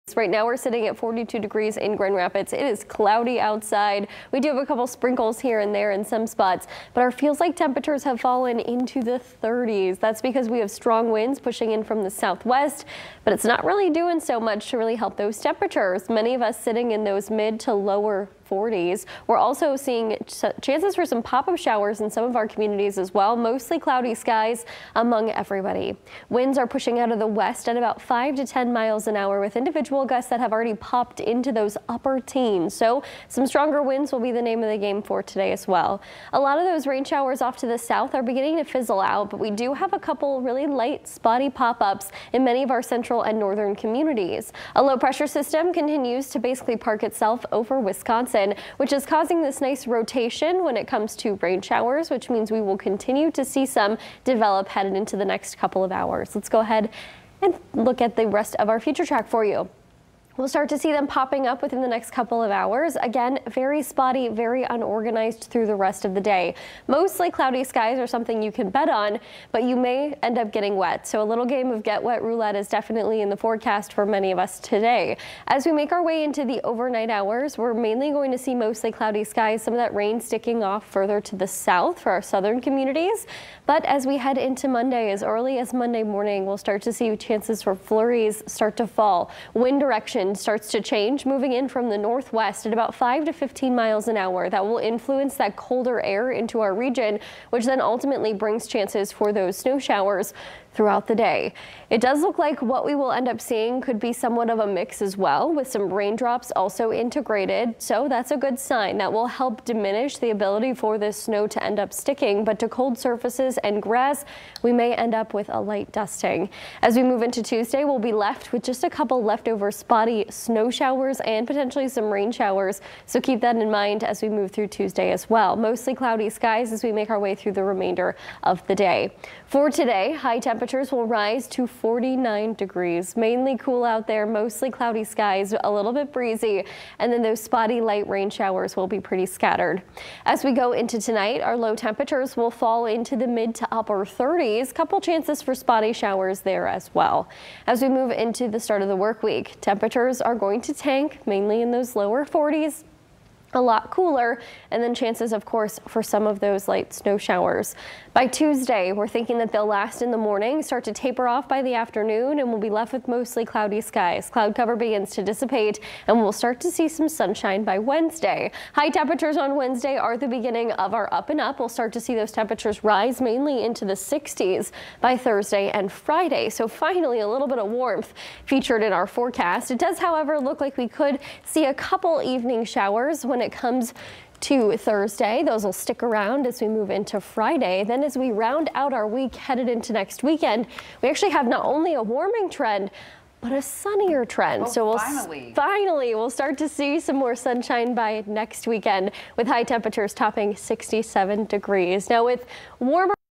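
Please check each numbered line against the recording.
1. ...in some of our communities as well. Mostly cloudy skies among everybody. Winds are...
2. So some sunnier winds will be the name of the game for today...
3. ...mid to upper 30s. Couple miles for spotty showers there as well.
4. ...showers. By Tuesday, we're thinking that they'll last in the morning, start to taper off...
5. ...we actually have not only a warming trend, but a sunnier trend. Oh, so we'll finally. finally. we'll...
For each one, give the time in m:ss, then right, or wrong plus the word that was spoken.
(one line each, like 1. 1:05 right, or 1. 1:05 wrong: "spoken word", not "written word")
1. 0:22 right
2. 0:32 wrong: "stronger", not "sunnier"
3. 2:23 wrong: "chances", not "miles"
4. 2:37 right
5. 3:11 right.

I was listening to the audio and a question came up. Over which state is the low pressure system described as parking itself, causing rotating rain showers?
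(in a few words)
Wisconsin.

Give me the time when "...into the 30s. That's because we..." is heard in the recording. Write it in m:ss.
0:08.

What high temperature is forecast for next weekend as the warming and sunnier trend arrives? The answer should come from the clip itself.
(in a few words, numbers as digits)
67 degrees.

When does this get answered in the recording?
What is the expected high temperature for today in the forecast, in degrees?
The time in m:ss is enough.
2:11.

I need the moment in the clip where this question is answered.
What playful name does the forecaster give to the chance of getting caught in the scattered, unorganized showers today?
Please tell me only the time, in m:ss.
1:11.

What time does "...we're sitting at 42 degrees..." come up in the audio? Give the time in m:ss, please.
0:00.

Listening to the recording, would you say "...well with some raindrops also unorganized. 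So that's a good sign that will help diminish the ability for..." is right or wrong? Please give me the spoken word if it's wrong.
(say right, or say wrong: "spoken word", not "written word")
wrong: "integrated", not "unorganized".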